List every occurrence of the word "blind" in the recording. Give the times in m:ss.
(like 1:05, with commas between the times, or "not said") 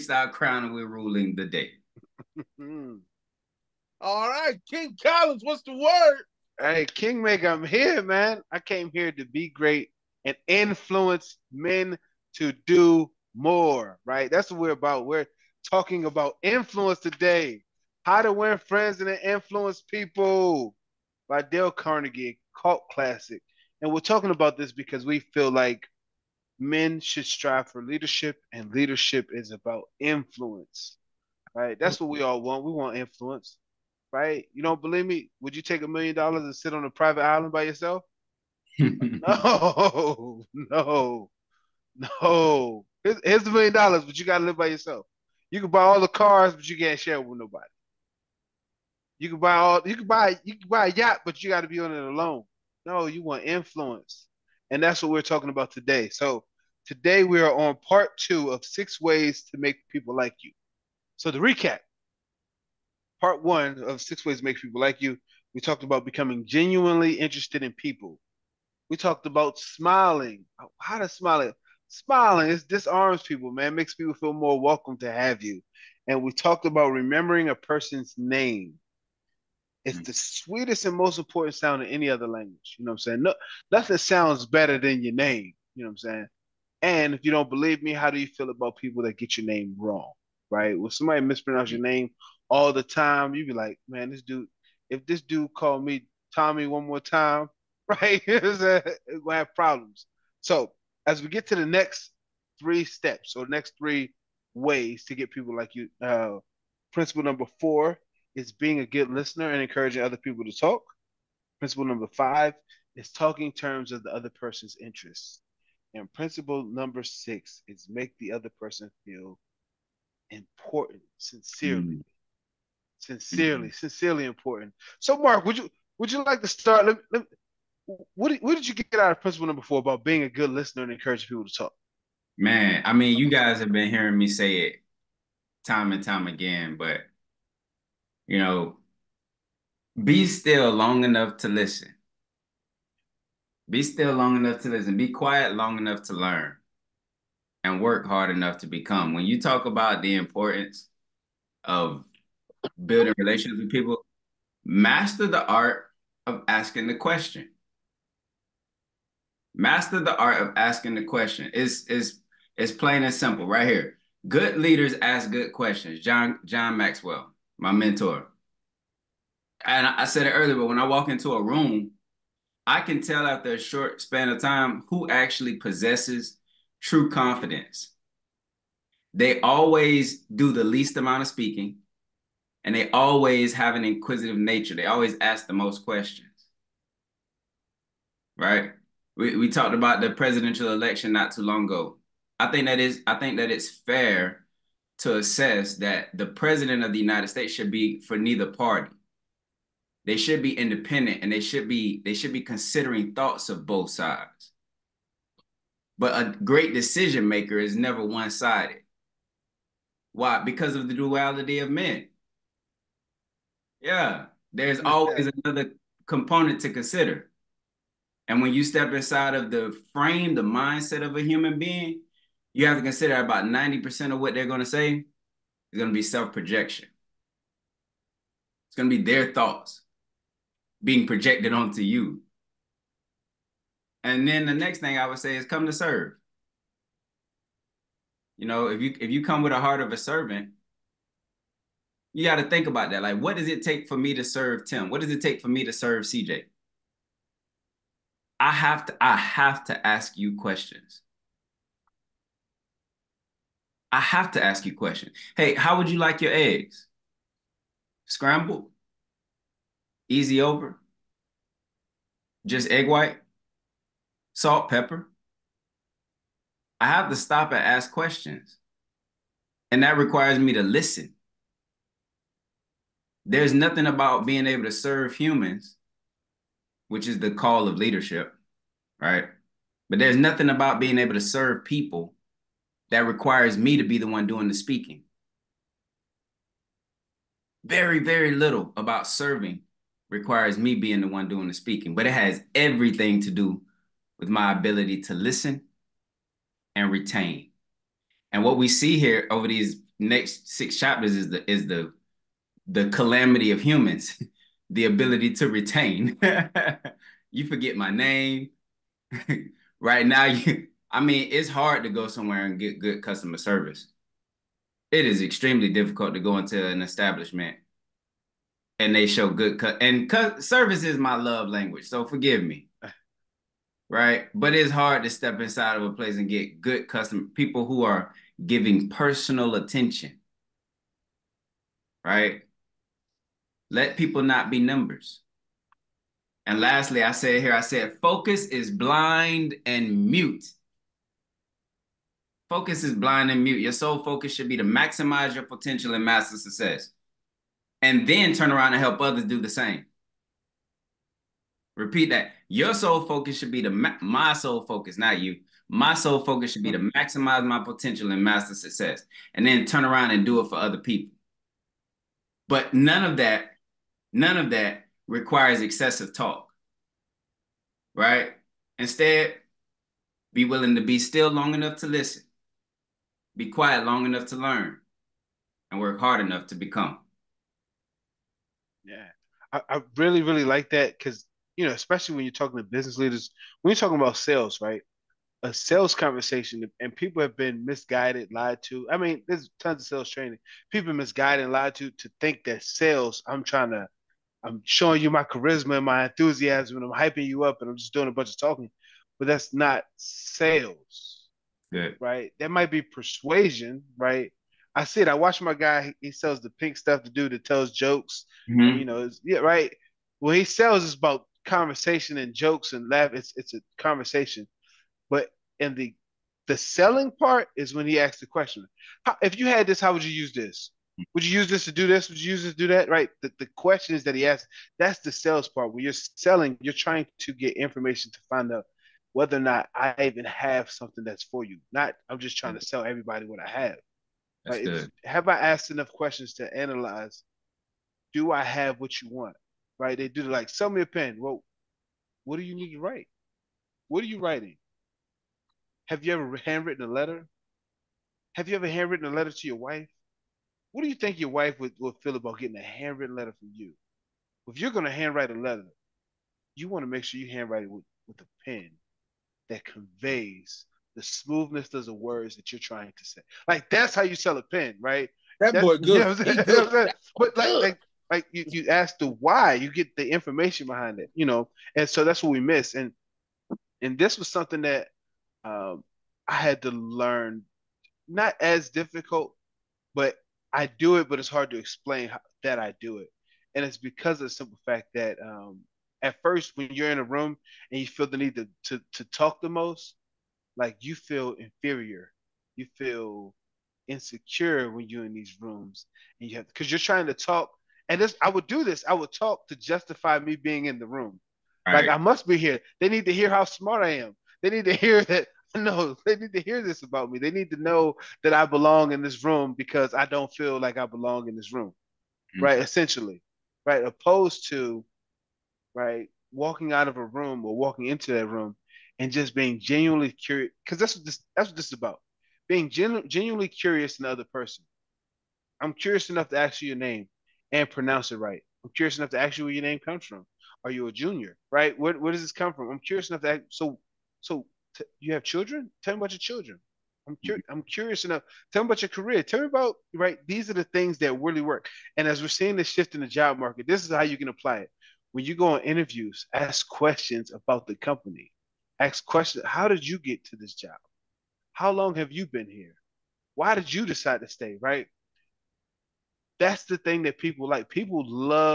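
5:38, 5:42.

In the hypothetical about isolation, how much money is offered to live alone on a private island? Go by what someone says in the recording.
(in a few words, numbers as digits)
a million dollars.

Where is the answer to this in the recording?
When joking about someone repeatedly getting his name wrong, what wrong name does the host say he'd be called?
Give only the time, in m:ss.
1:36.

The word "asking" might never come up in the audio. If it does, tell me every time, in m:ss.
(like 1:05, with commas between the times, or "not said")
2:36, 2:40.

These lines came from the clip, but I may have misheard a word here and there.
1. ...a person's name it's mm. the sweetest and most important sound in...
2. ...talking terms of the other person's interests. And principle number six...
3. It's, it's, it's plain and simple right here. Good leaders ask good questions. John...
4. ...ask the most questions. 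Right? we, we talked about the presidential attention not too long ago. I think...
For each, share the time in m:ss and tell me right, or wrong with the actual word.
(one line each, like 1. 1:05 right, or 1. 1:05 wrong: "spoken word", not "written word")
1. 1:17 right
2. 1:53 right
3. 2:41 right
4. 3:05 wrong: "election", not "attention".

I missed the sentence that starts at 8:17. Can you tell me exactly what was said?
And this, I would do this.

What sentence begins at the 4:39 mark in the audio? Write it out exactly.
But there's nothing about being able to serve people that requires me to be the one doing the speaking.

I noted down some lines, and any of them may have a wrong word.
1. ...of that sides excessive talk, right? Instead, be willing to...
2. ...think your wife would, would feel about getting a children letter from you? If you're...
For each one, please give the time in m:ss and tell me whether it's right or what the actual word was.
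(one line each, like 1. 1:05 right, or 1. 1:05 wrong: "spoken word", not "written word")
1. 6:04 wrong: "requires", not "sides"
2. 7:30 wrong: "handwritten", not "children".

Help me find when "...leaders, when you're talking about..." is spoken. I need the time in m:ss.
6:22.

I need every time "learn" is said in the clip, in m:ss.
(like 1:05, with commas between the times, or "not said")
2:26, 6:14, 7:56.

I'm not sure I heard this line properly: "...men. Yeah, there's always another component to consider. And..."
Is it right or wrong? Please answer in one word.
right.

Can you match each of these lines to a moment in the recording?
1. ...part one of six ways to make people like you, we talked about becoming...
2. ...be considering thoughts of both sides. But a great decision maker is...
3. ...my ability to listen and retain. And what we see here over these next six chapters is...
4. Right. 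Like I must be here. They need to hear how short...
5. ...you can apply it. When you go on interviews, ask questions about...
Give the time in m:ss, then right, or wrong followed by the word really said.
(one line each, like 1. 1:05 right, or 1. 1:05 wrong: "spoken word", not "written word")
1. 1:03 right
2. 3:22 right
3. 4:54 right
4. 8:21 wrong: "smart", not "short"
5. 9:04 right.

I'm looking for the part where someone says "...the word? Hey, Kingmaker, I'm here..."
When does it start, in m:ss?
0:05.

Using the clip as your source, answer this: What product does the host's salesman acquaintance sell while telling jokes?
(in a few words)
the pink stuff.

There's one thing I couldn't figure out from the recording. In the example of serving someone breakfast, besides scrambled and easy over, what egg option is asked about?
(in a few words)
egg white.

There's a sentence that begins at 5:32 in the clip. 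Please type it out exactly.
Right let people not be numbers.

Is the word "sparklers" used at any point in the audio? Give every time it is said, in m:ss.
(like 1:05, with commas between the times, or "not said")
not said.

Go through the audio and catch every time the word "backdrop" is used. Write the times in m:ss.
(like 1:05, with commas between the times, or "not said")
not said.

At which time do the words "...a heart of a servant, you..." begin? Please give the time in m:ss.
3:59.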